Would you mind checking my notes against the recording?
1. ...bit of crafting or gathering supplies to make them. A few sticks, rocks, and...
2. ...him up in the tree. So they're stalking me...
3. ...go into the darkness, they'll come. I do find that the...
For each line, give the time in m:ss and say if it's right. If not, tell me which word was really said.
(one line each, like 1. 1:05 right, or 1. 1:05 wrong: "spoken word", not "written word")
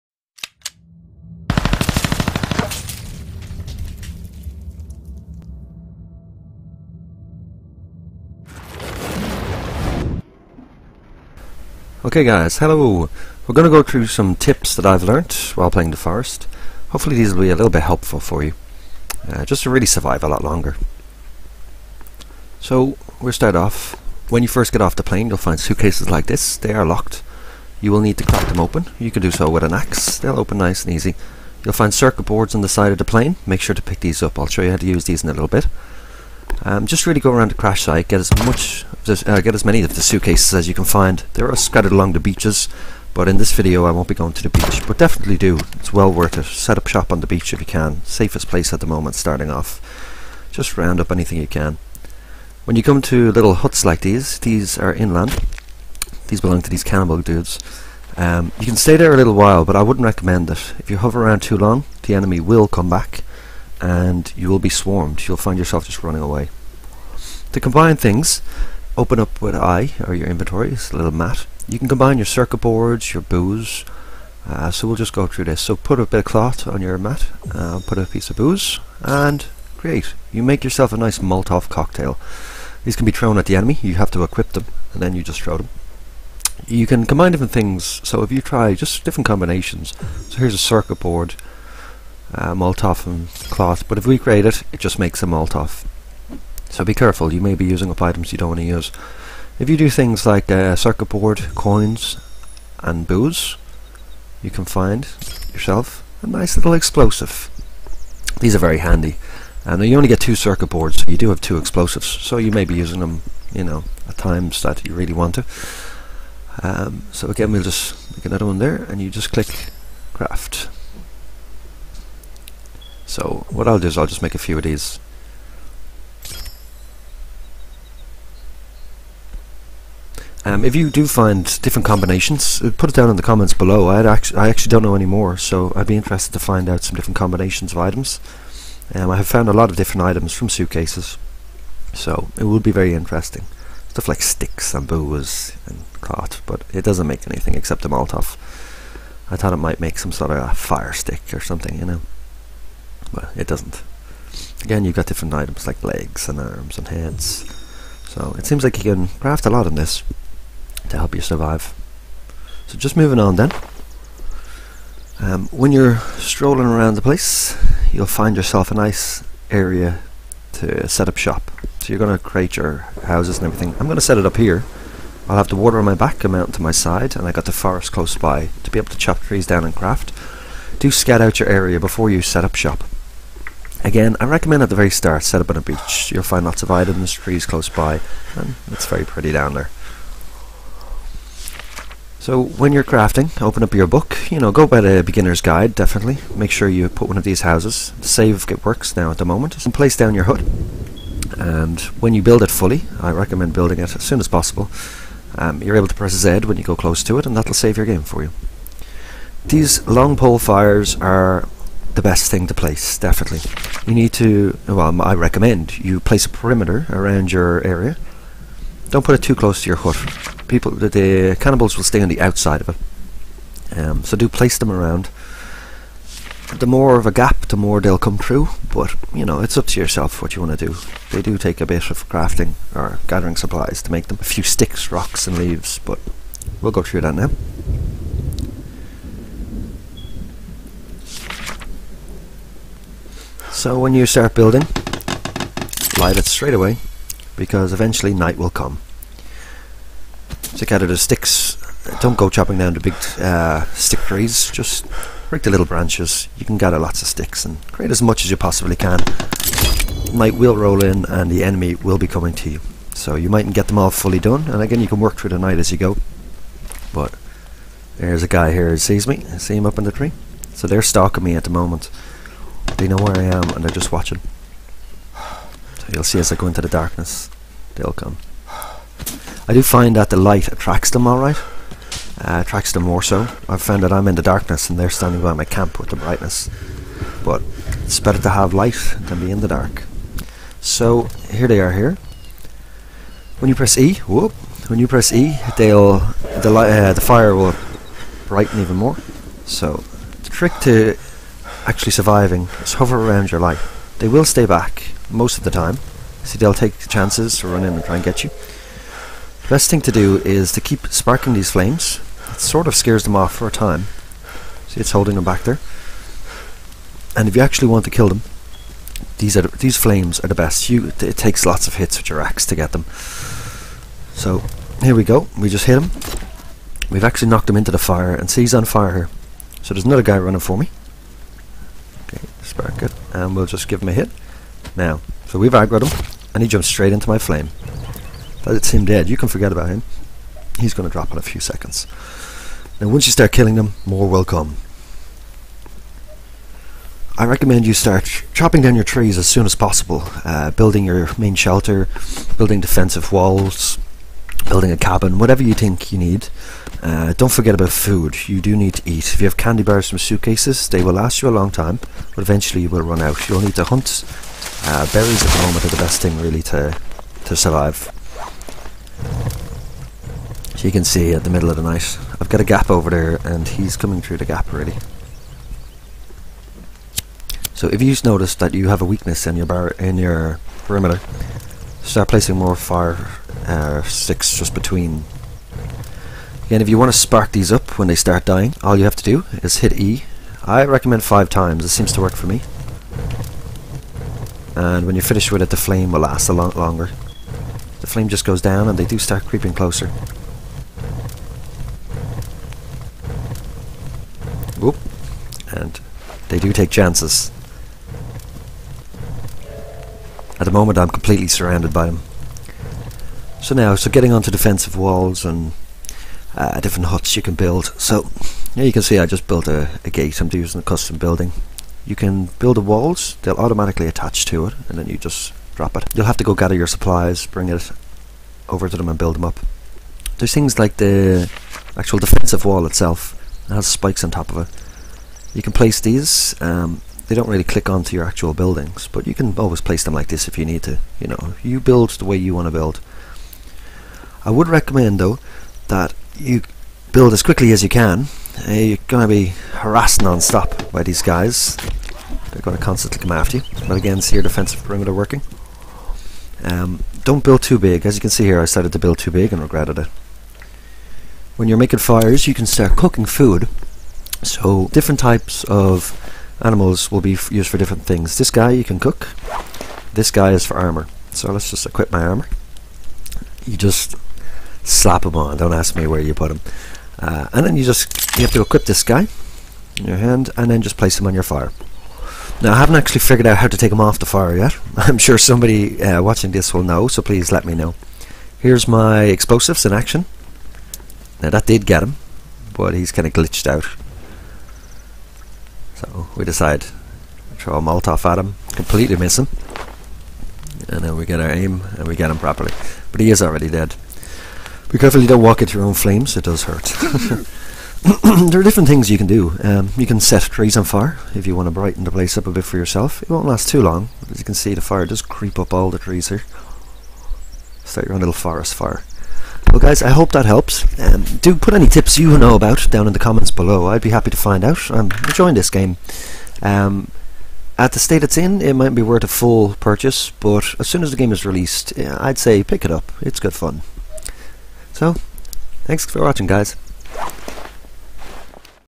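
1. 3:51 right
2. 4:29 right
3. 4:36 right.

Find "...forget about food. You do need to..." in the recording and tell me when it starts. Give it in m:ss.
5:57.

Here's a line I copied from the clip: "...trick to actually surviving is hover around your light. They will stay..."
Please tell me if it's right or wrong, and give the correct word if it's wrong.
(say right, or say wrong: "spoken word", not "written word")
right.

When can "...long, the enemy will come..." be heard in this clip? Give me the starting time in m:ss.
1:01.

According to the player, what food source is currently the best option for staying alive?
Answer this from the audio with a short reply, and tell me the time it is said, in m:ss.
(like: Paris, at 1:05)
Berries, at 6:04.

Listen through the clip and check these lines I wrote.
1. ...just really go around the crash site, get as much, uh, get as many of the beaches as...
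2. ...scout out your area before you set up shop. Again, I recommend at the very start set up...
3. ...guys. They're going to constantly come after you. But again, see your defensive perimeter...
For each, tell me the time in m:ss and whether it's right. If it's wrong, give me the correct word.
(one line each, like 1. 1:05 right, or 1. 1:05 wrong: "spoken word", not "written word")
1. 0:36 wrong: "suitcases", not "beaches"
2. 3:00 right
3. 7:31 right.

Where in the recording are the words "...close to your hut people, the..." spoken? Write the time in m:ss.
3:39.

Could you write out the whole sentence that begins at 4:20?
Night will roll in and the enemy will be coming to you.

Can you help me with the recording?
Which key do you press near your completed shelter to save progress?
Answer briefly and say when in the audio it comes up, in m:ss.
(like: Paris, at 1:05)
Z, at 3:26.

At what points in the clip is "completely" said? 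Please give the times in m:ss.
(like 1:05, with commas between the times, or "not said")
6:50, 8:18.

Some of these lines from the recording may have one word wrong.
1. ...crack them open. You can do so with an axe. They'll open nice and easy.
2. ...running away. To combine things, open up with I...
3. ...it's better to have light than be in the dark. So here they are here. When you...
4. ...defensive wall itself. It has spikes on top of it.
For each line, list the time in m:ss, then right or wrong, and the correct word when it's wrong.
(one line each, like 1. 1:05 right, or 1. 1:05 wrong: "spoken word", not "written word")
1. 0:28 right
2. 1:06 right
3. 4:47 right
4. 7:11 right.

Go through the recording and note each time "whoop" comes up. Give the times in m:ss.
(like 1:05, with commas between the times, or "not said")
4:54, 6:44.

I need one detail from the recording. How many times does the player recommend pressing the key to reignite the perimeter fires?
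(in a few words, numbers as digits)
5.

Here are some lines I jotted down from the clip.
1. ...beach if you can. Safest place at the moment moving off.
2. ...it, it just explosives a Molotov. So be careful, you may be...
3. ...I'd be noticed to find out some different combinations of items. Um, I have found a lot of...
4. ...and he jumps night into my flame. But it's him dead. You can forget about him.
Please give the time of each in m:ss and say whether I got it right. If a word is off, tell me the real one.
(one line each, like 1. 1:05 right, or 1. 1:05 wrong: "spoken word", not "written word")
1. 0:47 wrong: "starting", not "moving"
2. 1:34 wrong: "makes", not "explosives"
3. 2:15 wrong: "interested", not "noticed"
4. 5:36 wrong: "straight", not "night".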